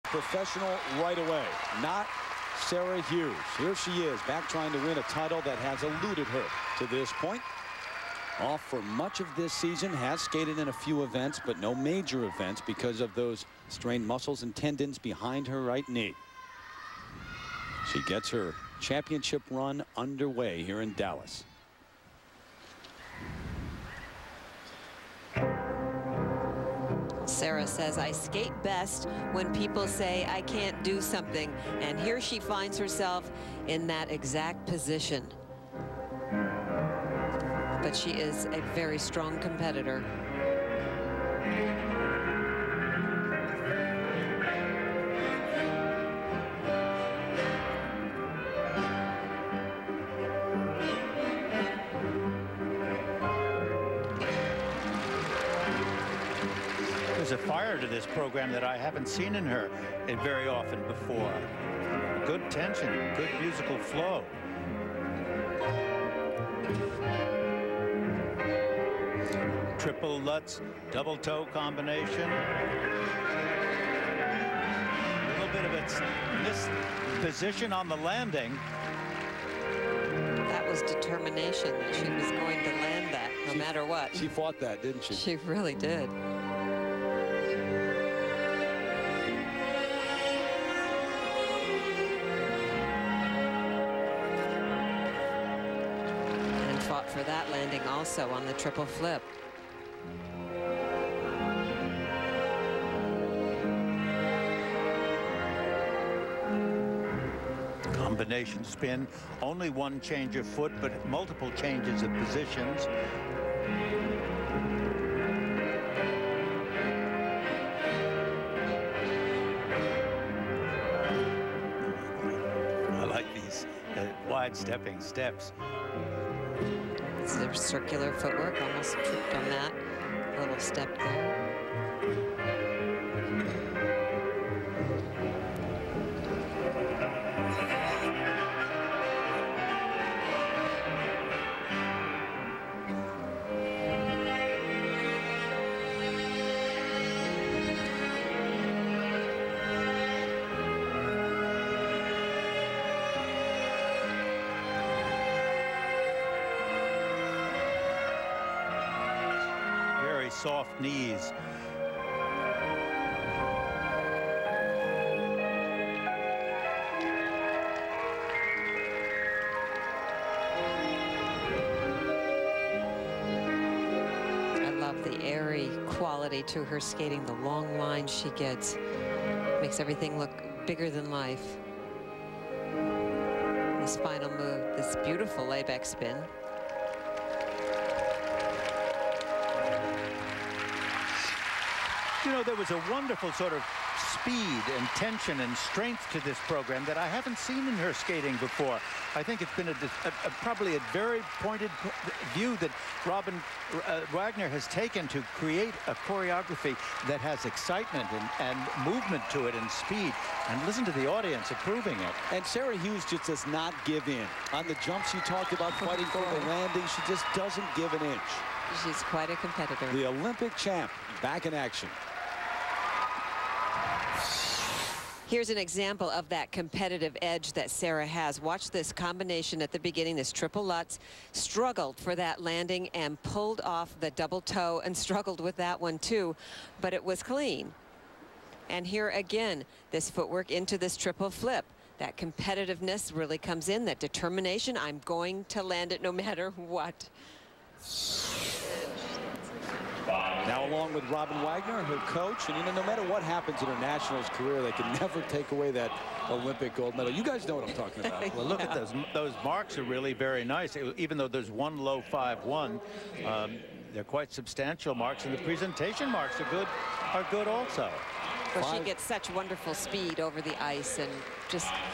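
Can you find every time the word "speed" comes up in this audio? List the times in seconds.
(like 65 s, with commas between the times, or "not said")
194 s, 209 s, 269 s.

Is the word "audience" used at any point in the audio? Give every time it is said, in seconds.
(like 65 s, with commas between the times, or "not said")
211 s.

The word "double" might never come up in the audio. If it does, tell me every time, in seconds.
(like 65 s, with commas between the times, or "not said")
70 s, 234 s.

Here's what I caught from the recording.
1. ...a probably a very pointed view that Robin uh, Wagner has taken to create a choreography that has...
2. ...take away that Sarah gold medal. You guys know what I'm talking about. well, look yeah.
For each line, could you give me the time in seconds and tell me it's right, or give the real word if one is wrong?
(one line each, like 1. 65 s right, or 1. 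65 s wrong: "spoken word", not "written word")
1. 200 s right
2. 255 s wrong: "Olympic", not "Sarah".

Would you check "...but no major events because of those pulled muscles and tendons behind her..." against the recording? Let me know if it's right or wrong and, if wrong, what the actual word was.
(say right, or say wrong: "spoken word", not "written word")
wrong: "strained", not "pulled".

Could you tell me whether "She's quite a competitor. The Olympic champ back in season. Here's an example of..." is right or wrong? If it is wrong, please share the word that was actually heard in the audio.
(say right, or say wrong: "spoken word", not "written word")
wrong: "action", not "season".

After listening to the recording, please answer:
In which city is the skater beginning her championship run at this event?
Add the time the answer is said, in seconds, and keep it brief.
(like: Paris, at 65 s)
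Dallas, at 20 s.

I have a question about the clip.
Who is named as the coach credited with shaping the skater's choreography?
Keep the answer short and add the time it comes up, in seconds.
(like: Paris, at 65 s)
Robin Wagner, at 251 s.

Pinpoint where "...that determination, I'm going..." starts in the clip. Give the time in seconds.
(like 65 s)
243 s.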